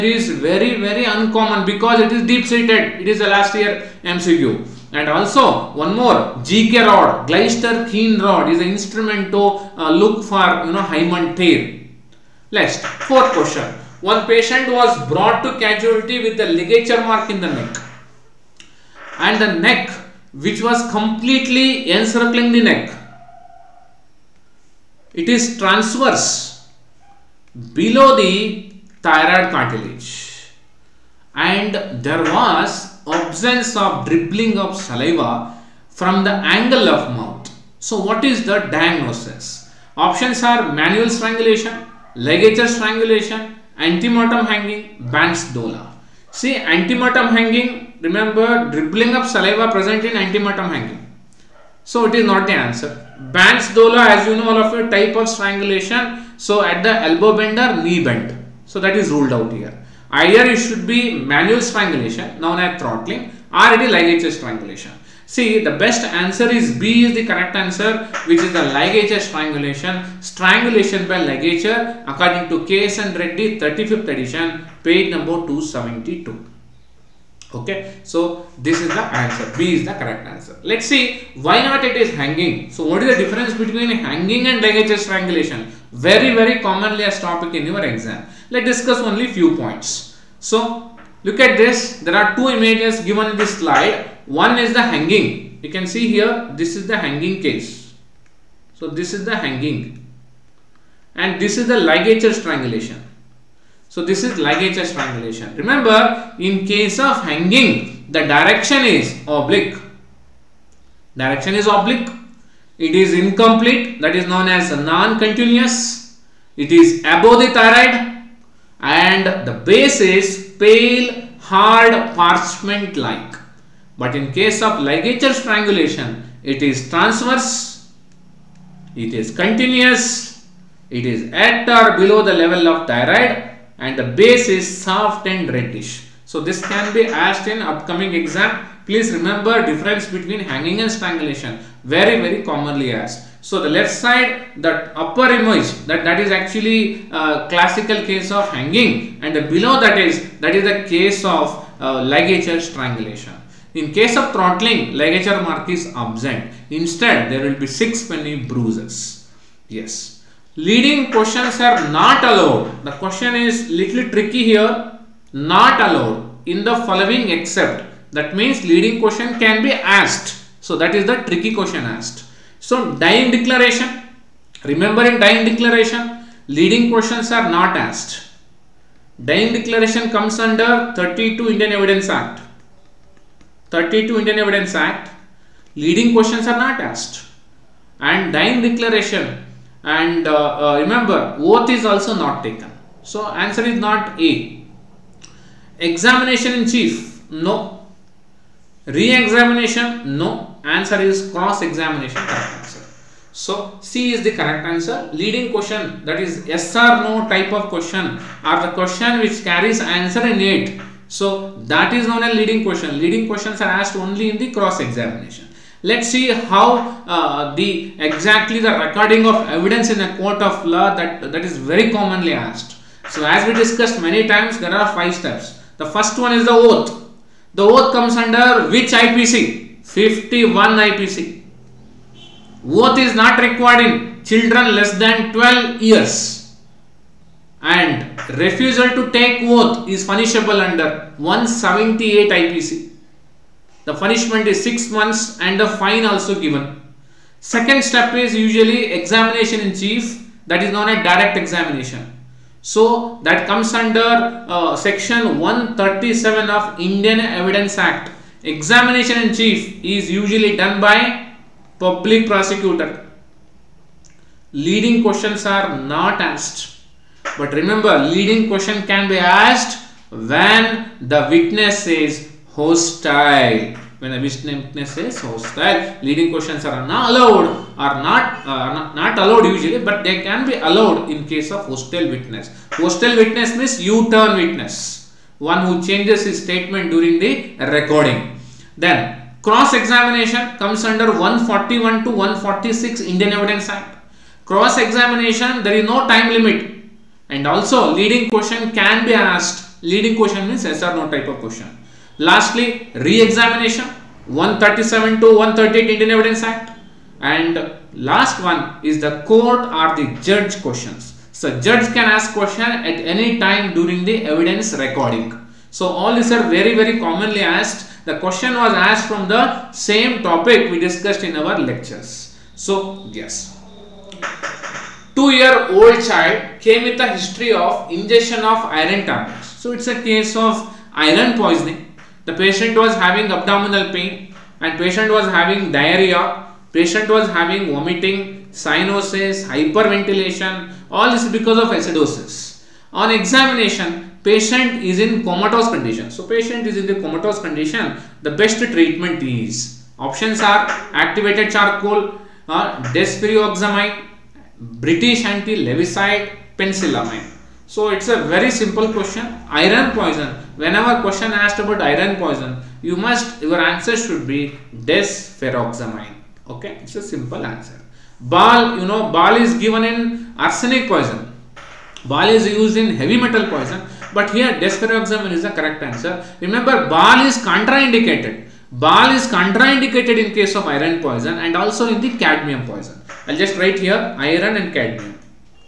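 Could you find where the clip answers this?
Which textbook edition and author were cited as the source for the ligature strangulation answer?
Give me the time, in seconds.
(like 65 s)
72 s.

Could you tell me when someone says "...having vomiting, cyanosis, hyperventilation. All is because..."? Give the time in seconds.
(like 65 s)
337 s.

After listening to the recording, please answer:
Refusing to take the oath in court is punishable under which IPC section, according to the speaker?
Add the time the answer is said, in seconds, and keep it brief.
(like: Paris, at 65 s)
178 IPC, at 241 s.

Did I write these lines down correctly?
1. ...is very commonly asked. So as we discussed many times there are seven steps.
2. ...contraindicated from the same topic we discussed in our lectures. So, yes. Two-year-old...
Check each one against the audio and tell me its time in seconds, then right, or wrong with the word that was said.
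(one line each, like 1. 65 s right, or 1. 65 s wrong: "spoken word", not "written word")
1. 221 s wrong: "five", not "seven"
2. 318 s wrong: "asked", not "contraindicated".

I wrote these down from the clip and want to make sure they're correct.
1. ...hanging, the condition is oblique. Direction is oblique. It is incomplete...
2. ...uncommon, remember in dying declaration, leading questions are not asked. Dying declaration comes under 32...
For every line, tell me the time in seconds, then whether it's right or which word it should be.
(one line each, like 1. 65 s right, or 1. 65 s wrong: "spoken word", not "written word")
1. 107 s wrong: "direction", not "condition"
2. 173 s wrong: "declaration", not "uncommon".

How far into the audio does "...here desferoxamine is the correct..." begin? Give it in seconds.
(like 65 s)
374 s.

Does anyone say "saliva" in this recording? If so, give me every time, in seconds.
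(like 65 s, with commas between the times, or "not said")
34 s, 49 s.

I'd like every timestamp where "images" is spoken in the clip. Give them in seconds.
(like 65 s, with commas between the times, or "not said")
92 s, 145 s.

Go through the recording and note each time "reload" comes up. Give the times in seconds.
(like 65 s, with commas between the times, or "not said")
not said.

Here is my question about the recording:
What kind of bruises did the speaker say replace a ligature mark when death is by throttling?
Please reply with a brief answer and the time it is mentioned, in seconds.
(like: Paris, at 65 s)
six penny bruises, at 157 s.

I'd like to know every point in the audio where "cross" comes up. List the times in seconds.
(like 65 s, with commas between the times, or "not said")
201 s, 214 s, 289 s, 294 s.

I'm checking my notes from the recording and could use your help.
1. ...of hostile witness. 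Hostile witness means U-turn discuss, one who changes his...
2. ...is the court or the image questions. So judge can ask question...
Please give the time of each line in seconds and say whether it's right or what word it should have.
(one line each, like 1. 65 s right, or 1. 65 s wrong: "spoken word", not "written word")
1. 281 s wrong: "witness", not "discuss"
2. 308 s wrong: "judge", not "image".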